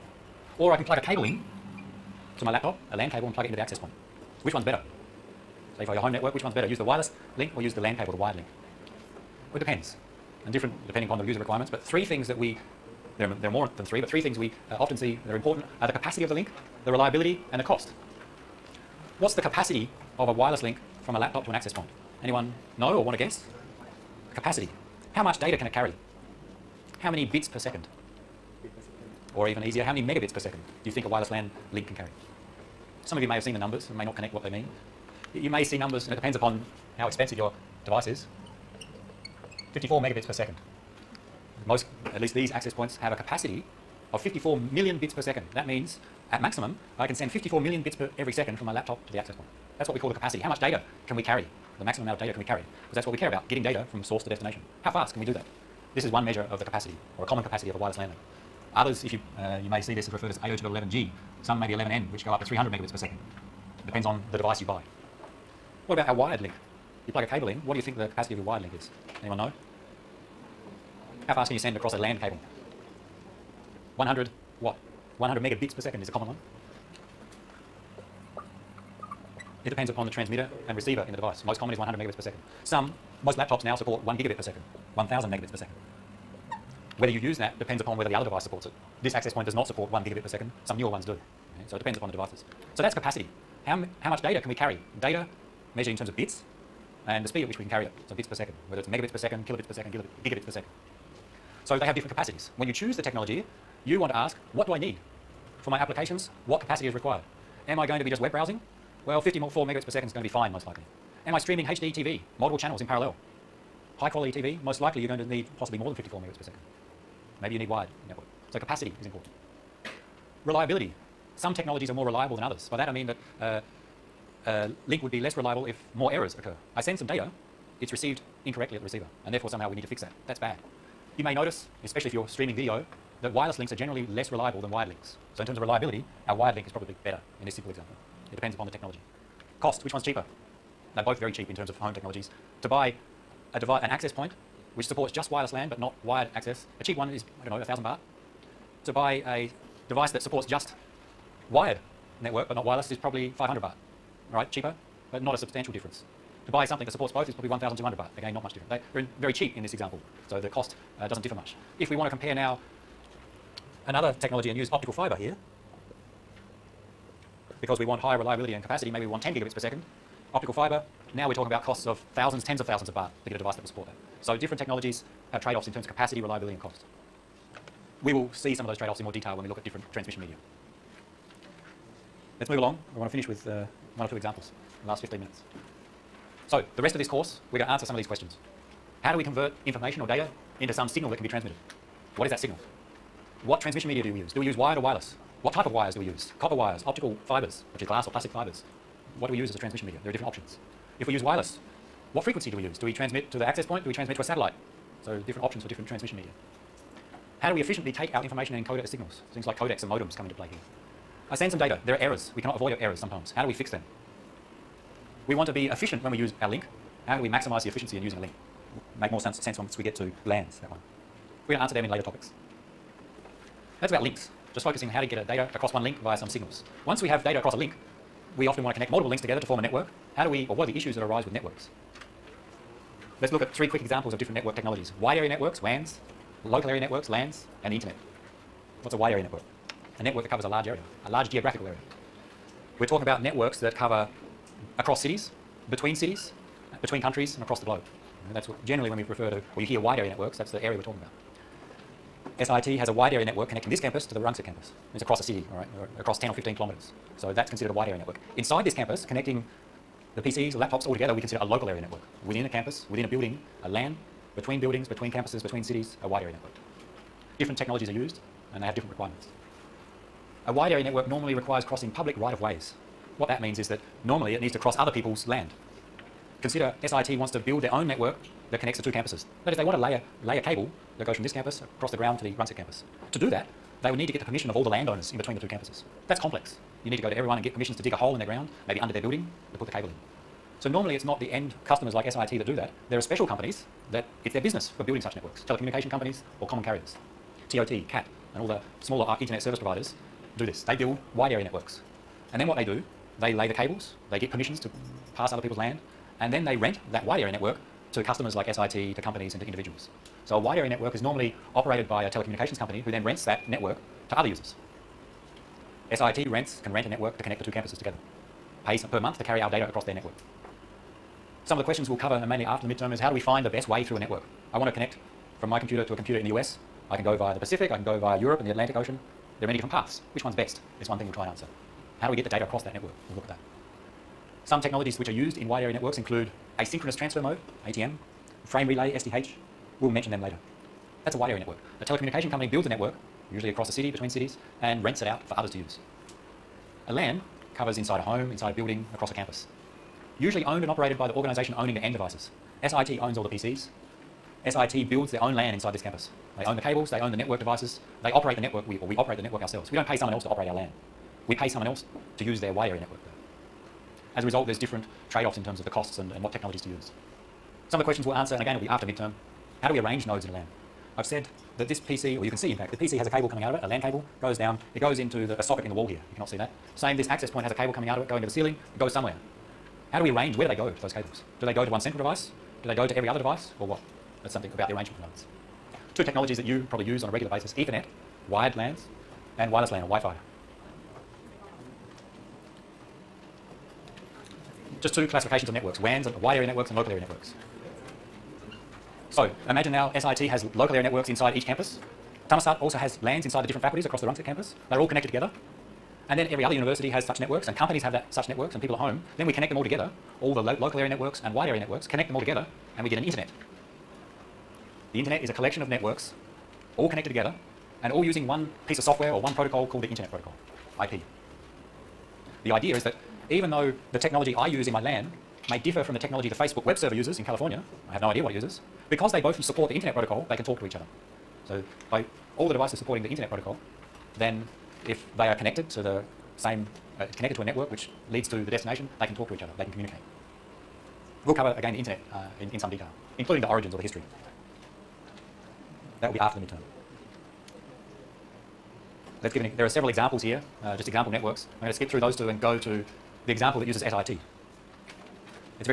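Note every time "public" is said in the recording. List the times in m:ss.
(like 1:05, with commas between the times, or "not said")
4:31.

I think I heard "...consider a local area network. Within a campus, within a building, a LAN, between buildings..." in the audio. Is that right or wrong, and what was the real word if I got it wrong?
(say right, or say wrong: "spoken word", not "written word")
right.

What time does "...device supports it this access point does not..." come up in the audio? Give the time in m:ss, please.
1:28.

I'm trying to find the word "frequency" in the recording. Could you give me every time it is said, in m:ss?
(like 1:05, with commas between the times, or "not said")
3:22.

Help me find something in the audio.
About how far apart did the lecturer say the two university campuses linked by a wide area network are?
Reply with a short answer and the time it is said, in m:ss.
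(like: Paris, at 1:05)
10 or 15 kilometres, at 4:16.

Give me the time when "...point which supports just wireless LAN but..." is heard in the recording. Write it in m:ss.
2:24.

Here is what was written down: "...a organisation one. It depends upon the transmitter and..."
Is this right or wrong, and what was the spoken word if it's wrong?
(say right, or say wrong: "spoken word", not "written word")
wrong: "common", not "organisation".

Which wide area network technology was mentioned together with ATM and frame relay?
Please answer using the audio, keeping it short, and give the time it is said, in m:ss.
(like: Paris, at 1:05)
SDH, at 5:38.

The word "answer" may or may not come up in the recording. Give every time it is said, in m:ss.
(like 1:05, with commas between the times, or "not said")
3:07, 3:41, 5:31, 6:08.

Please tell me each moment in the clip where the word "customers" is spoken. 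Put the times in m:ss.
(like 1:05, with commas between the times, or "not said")
4:51, 5:08.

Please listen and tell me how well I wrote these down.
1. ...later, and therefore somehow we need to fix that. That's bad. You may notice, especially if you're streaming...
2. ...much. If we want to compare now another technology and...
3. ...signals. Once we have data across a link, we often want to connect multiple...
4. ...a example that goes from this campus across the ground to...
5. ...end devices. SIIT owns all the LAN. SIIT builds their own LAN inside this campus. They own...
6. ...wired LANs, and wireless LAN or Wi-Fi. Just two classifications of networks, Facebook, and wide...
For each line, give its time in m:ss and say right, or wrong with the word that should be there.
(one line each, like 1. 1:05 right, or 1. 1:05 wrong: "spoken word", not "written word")
1. 2:08 wrong: "receiver", not "later"
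2. 2:41 right
3. 3:46 right
4. 4:40 wrong: "cable", not "example"
5. 5:51 wrong: "PCs", not "LAN"
6. 6:28 wrong: "WANs", not "Facebook".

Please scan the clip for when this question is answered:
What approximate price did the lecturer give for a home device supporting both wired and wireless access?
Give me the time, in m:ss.
2:37.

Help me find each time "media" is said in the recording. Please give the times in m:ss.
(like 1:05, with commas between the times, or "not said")
3:00, 3:13, 3:19, 3:26.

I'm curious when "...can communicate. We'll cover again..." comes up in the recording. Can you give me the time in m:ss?
7:19.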